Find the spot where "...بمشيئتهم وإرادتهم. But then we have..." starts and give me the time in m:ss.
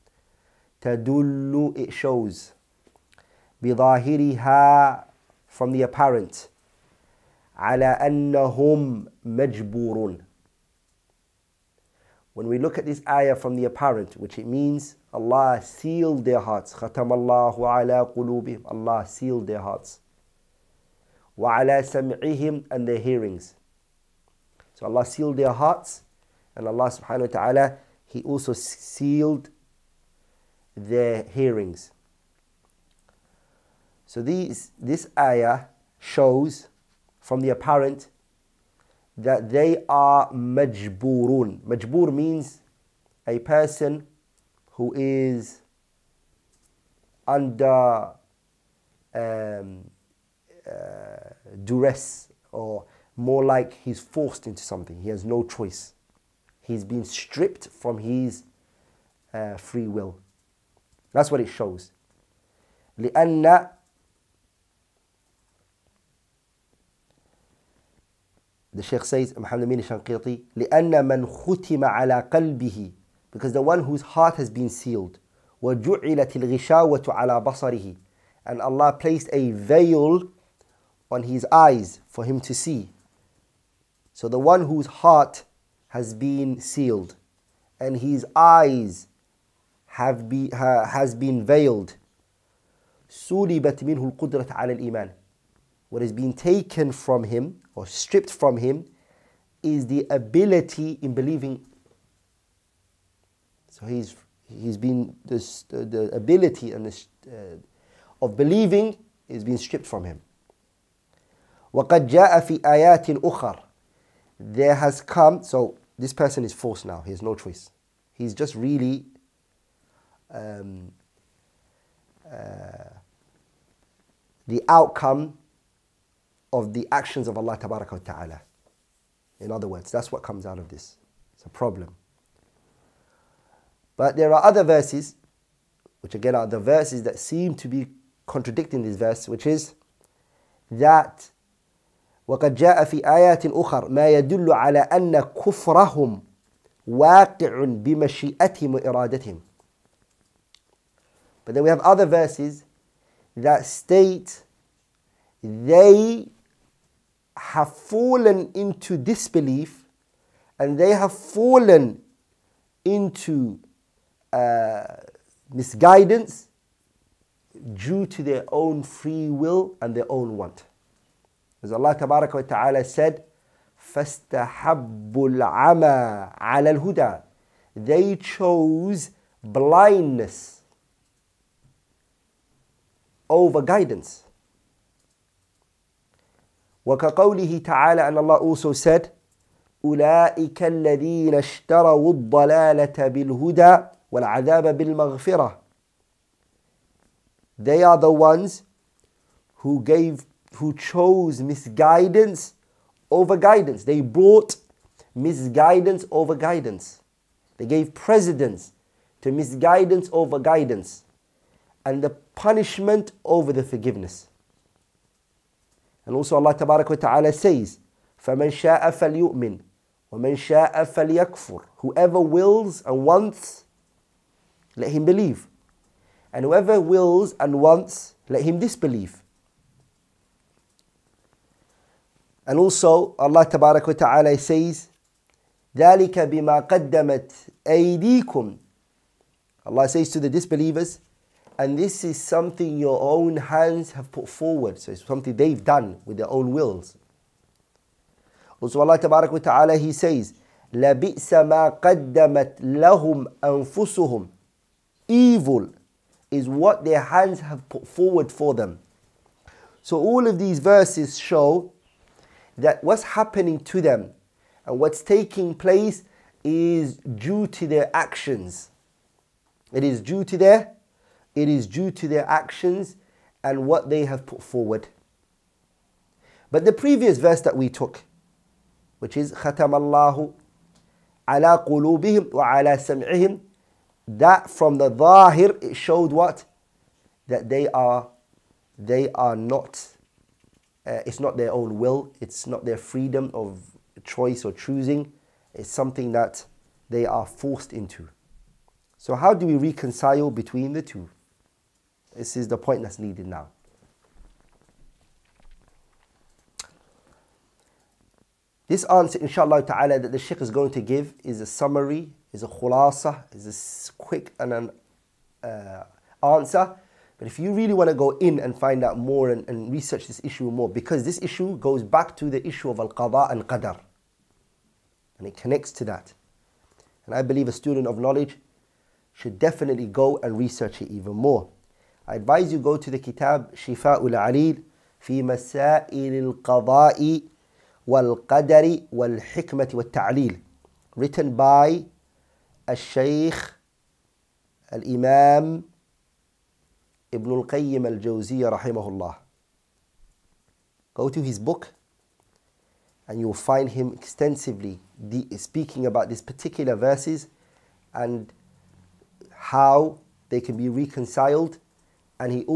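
2:27.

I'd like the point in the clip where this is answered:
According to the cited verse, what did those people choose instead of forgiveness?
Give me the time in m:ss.
3:32.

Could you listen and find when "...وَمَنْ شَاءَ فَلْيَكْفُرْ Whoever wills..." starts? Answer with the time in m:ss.
3:40.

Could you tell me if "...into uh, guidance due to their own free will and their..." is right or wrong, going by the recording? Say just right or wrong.
wrong.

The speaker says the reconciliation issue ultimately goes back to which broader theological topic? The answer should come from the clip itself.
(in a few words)
Al-qada and qadar.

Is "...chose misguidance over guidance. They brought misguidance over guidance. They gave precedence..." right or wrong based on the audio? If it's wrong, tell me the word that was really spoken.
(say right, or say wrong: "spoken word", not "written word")
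right.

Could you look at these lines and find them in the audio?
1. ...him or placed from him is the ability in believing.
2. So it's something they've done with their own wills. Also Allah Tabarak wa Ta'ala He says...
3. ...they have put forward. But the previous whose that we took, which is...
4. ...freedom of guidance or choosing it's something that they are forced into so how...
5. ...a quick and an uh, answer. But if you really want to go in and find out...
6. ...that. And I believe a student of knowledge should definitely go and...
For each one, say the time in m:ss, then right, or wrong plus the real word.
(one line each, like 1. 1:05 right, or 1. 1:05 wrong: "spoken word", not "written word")
1. 1:37 wrong: "stripped", not "placed"
2. 4:04 right
3. 4:33 wrong: "verse", not "whose"
4. 4:52 wrong: "choice", not "guidance"
5. 5:13 right
6. 5:25 right.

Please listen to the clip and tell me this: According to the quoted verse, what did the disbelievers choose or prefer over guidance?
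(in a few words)
Blindness.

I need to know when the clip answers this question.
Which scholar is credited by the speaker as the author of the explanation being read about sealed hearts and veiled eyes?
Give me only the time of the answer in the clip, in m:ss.
1:09.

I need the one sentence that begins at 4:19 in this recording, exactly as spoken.
So all of these verses show that what's happening to them and what's taking place is due to their actions.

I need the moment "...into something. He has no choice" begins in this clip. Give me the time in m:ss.
0:54.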